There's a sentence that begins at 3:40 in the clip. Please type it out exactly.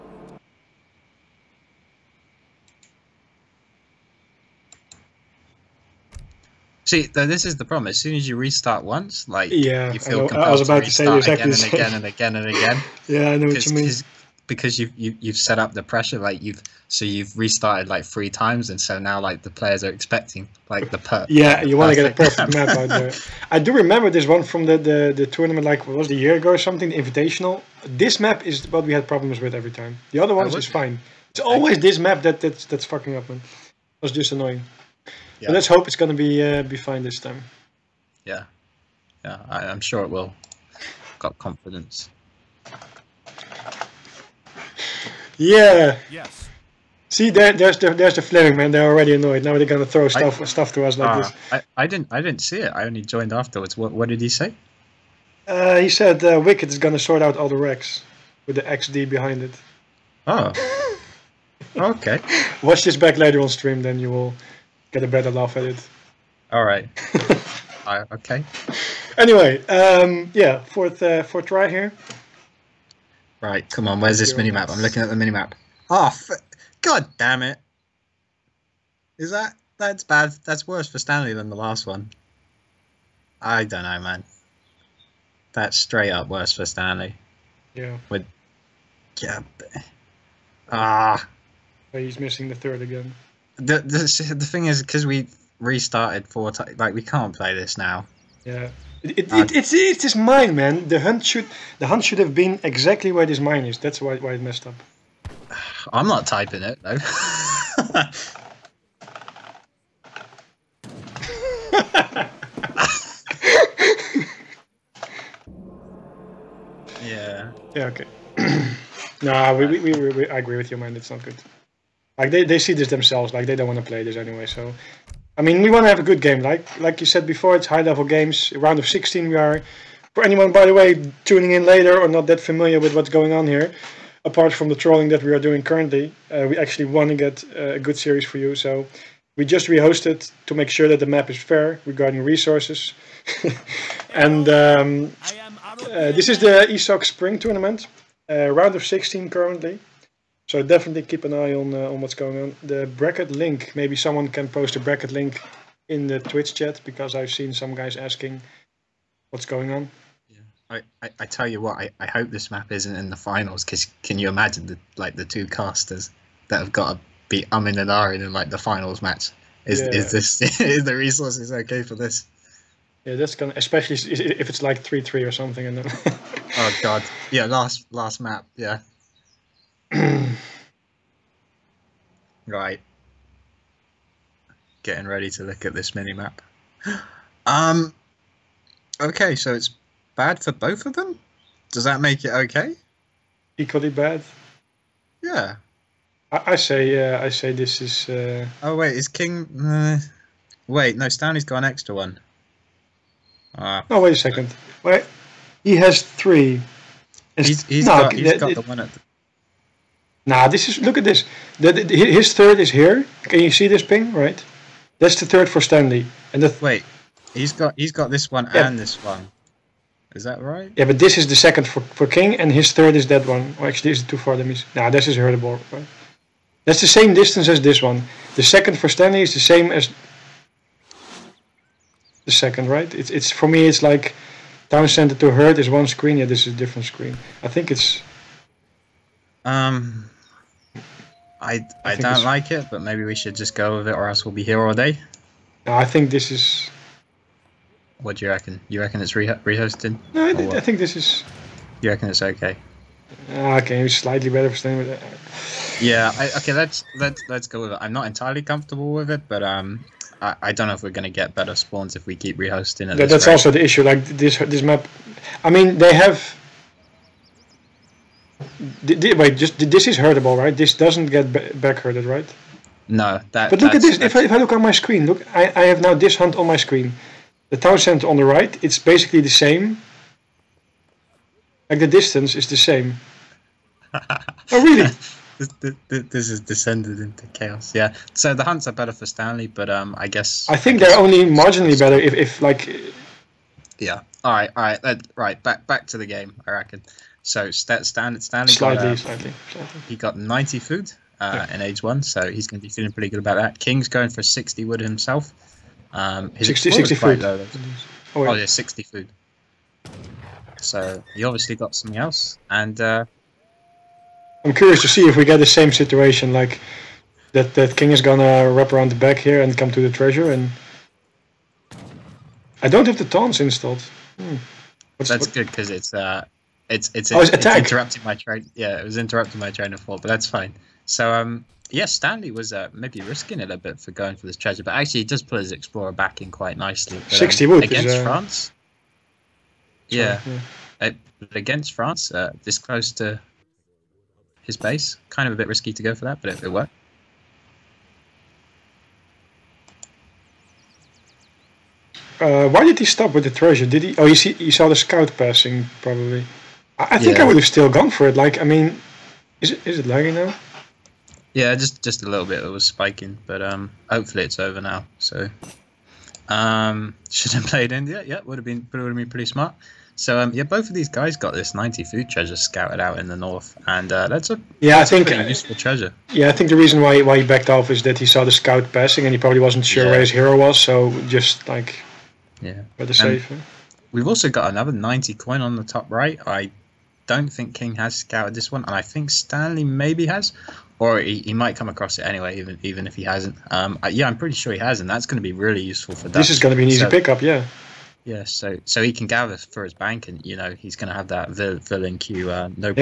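Yeah, but this is the second for, for King, and his third is that one.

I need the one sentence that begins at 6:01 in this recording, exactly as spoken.
Yeah, just just a little bit.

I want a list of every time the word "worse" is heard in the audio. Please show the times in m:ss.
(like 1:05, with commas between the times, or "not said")
1:20, 1:26.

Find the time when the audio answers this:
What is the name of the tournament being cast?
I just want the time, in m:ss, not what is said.
2:26.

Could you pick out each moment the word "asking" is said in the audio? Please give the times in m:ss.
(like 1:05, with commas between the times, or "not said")
2:37.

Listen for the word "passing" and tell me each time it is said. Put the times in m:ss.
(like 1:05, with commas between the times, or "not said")
5:55, 6:18.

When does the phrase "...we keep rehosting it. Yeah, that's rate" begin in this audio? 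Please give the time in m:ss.
4:22.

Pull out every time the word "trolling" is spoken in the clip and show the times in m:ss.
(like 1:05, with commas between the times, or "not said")
2:14.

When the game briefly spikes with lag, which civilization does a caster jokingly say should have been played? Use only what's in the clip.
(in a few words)
India.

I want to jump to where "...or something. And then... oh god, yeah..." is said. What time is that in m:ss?
2:55.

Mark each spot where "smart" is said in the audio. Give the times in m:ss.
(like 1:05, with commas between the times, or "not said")
6:09.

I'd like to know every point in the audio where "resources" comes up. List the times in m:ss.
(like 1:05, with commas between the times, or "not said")
2:22, 2:50.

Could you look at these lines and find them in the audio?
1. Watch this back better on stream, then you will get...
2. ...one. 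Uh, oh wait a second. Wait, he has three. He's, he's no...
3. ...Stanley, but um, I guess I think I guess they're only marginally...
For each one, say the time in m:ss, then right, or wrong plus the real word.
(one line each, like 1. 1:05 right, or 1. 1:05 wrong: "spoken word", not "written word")
1. 1:02 wrong: "later", not "better"
2. 3:21 right
3. 4:49 right.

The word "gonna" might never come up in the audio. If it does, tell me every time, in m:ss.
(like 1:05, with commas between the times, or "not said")
0:35, 0:49, 0:56, 2:53, 4:20.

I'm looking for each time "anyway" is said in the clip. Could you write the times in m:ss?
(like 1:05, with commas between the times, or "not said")
1:09, 2:04, 6:32.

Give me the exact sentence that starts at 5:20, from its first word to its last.
And I don't have the taunts installed.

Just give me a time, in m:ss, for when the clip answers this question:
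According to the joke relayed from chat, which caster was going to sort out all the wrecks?
0:56.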